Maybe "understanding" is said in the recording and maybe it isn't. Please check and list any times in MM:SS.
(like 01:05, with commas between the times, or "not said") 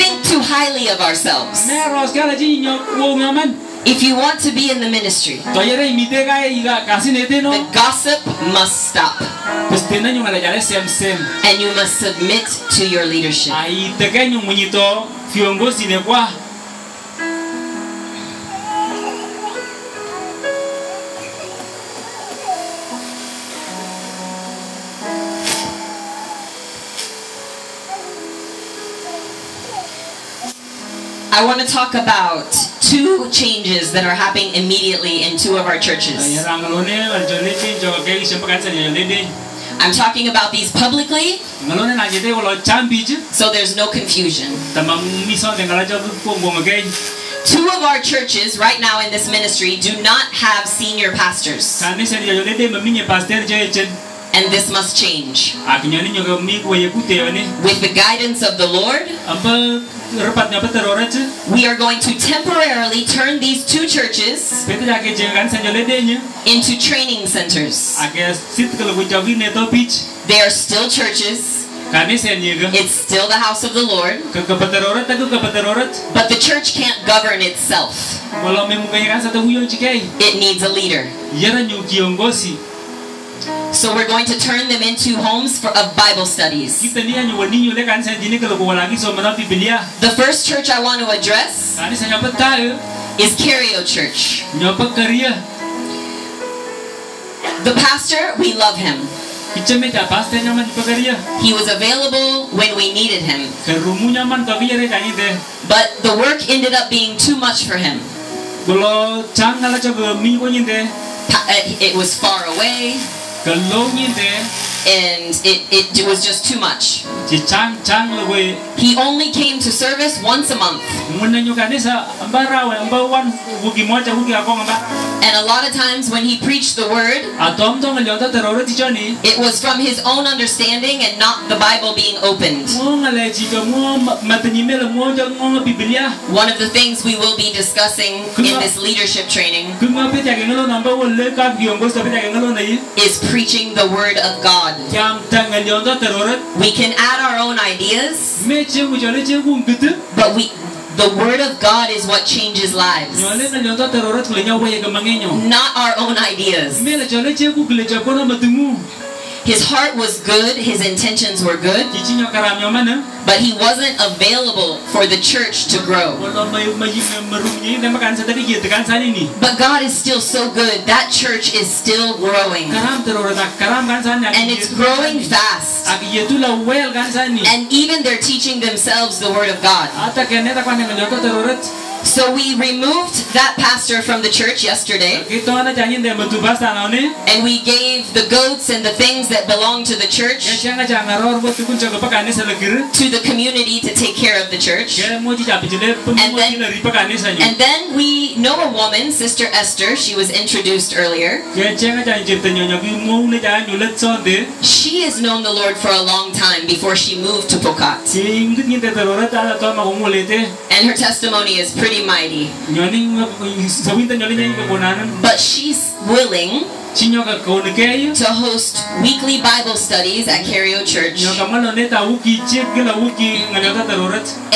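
02:10.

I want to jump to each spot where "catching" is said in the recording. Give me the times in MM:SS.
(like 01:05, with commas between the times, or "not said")
not said.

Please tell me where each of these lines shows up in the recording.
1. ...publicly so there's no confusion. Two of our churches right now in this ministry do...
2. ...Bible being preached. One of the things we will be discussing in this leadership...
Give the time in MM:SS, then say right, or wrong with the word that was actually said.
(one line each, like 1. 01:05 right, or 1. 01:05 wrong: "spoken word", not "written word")
1. 00:40 right
2. 02:11 wrong: "opened", not "preached".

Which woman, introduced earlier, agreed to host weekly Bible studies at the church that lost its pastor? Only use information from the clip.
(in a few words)
Sister Esther.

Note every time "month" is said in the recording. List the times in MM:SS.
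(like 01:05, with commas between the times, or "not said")
02:00.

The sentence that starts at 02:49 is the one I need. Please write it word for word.
But God is still so good, that church is still growing.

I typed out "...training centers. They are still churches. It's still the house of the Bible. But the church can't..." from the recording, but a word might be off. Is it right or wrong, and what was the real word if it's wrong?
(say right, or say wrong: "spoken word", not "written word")
wrong: "Lord", not "Bible".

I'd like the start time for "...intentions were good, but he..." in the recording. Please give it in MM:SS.
02:40.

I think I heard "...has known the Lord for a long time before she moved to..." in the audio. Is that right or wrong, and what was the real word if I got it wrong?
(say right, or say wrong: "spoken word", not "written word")
right.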